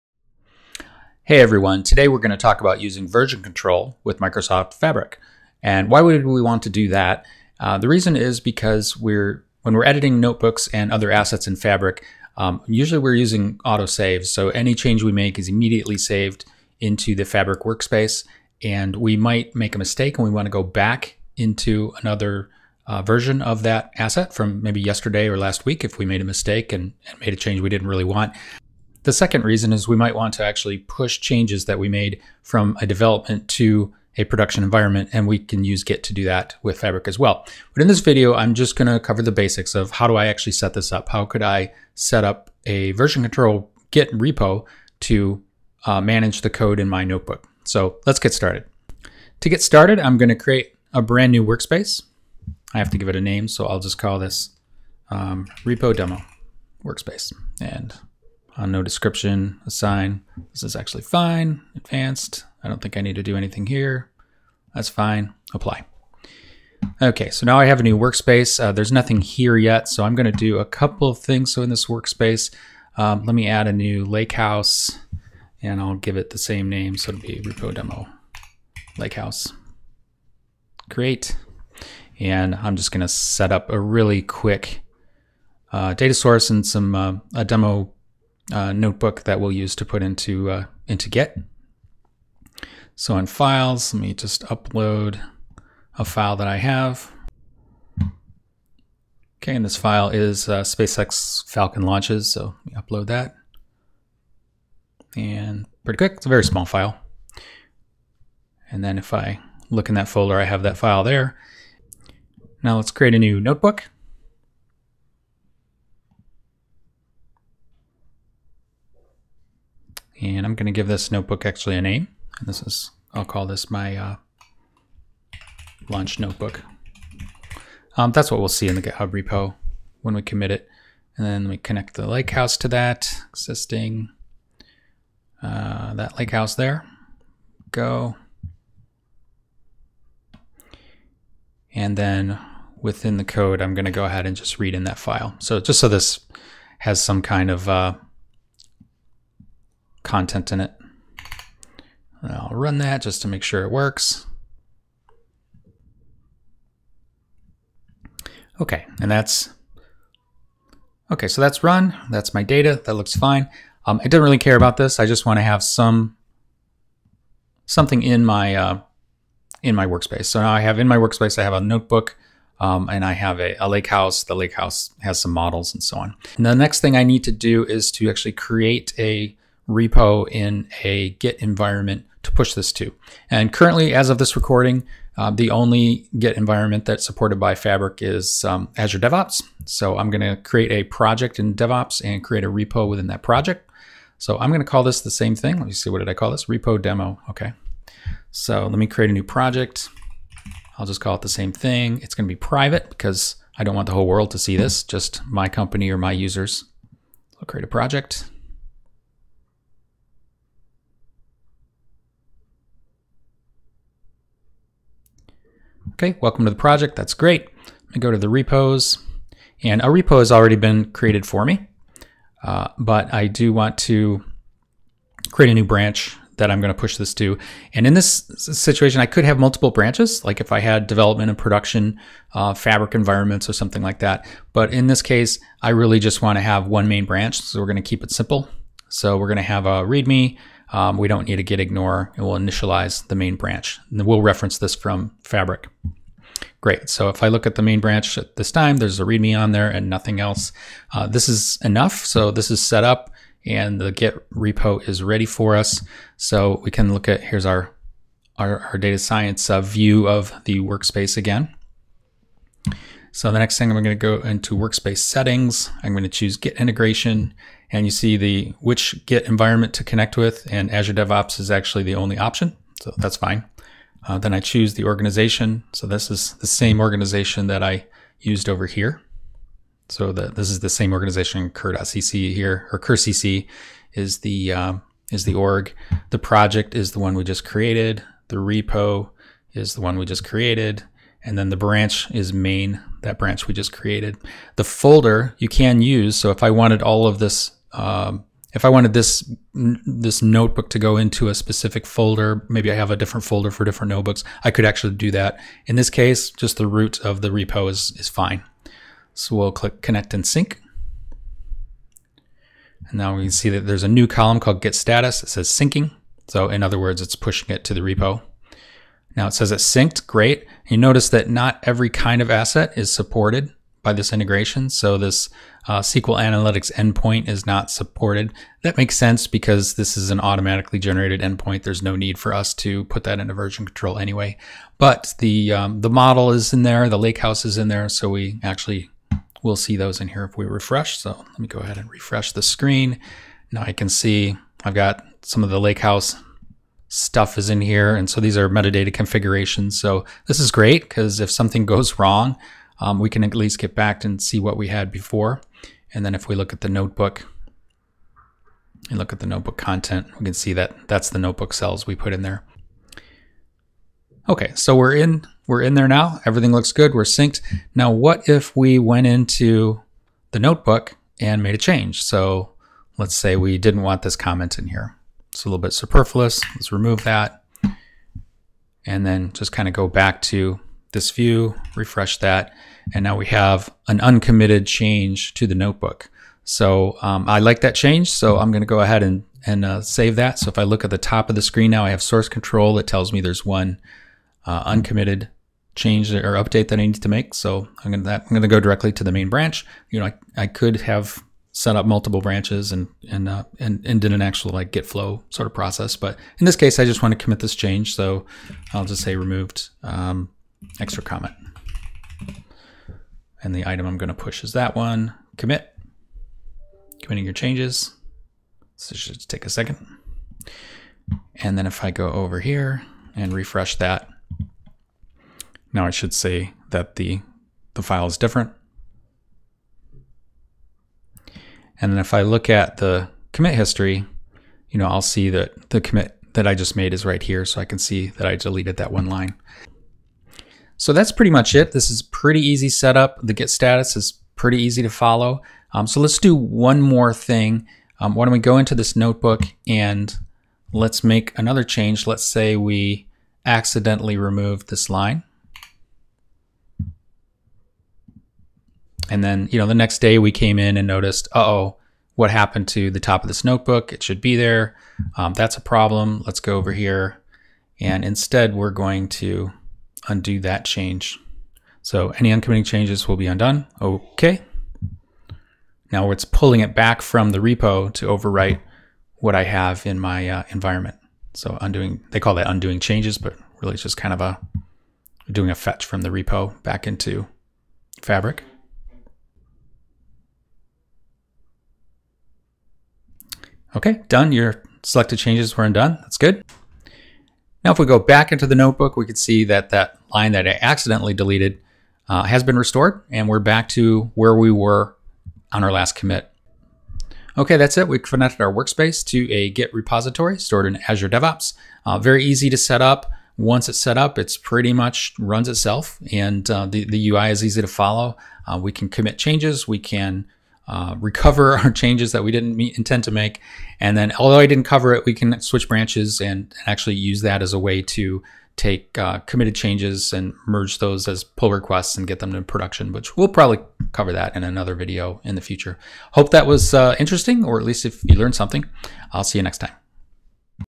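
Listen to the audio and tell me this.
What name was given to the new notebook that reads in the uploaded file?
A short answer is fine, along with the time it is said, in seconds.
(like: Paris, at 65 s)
launch notebook, at 125 s.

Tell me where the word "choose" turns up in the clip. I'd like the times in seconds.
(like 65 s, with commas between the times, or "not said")
266 s, 274 s.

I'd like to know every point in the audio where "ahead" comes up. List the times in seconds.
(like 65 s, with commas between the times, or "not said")
144 s, 341 s, 388 s.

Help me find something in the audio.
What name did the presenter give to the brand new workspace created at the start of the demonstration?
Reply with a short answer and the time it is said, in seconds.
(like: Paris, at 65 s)
repo demo workspace, at 55 s.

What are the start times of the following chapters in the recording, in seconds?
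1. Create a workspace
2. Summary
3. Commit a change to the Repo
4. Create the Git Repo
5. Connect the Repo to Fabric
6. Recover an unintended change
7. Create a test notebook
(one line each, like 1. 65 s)
1. 50 s
2. 506 s
3. 367 s
4. 180 s
5. 260 s
6. 445 s
7. 115 s.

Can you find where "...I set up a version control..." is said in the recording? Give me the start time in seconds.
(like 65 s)
41 s.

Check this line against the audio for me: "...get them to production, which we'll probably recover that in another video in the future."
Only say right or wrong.
wrong.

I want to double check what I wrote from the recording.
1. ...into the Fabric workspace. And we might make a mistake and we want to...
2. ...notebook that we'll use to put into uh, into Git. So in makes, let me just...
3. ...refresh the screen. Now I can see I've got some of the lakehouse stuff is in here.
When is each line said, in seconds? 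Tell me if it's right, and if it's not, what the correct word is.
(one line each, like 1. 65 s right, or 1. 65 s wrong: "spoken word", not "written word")
1. 16 s right
2. 88 s wrong: "files", not "makes"
3. 341 s right.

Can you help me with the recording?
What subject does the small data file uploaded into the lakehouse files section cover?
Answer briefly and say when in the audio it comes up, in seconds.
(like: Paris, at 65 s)
SpaceX Falcon launches, at 100 s.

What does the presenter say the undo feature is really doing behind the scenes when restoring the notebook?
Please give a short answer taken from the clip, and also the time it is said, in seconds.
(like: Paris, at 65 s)
a fetch from the repo, at 485 s.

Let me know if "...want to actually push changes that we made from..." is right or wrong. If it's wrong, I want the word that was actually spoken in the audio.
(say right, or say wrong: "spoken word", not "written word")
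right.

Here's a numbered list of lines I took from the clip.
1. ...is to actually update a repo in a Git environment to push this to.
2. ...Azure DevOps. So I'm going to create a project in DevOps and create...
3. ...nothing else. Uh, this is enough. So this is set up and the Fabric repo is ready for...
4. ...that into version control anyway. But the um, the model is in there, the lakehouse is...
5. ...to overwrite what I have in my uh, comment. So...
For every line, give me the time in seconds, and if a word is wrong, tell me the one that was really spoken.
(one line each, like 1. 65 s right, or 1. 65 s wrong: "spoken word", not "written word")
1. 177 s wrong: "create", not "update"
2. 188 s right
3. 249 s wrong: "Git", not "Fabric"
4. 333 s right
5. 477 s wrong: "environment", not "comment".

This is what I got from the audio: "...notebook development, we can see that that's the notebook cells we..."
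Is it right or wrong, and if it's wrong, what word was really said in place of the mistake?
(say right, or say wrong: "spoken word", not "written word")
wrong: "content", not "development".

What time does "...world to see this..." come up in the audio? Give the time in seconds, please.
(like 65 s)
204 s.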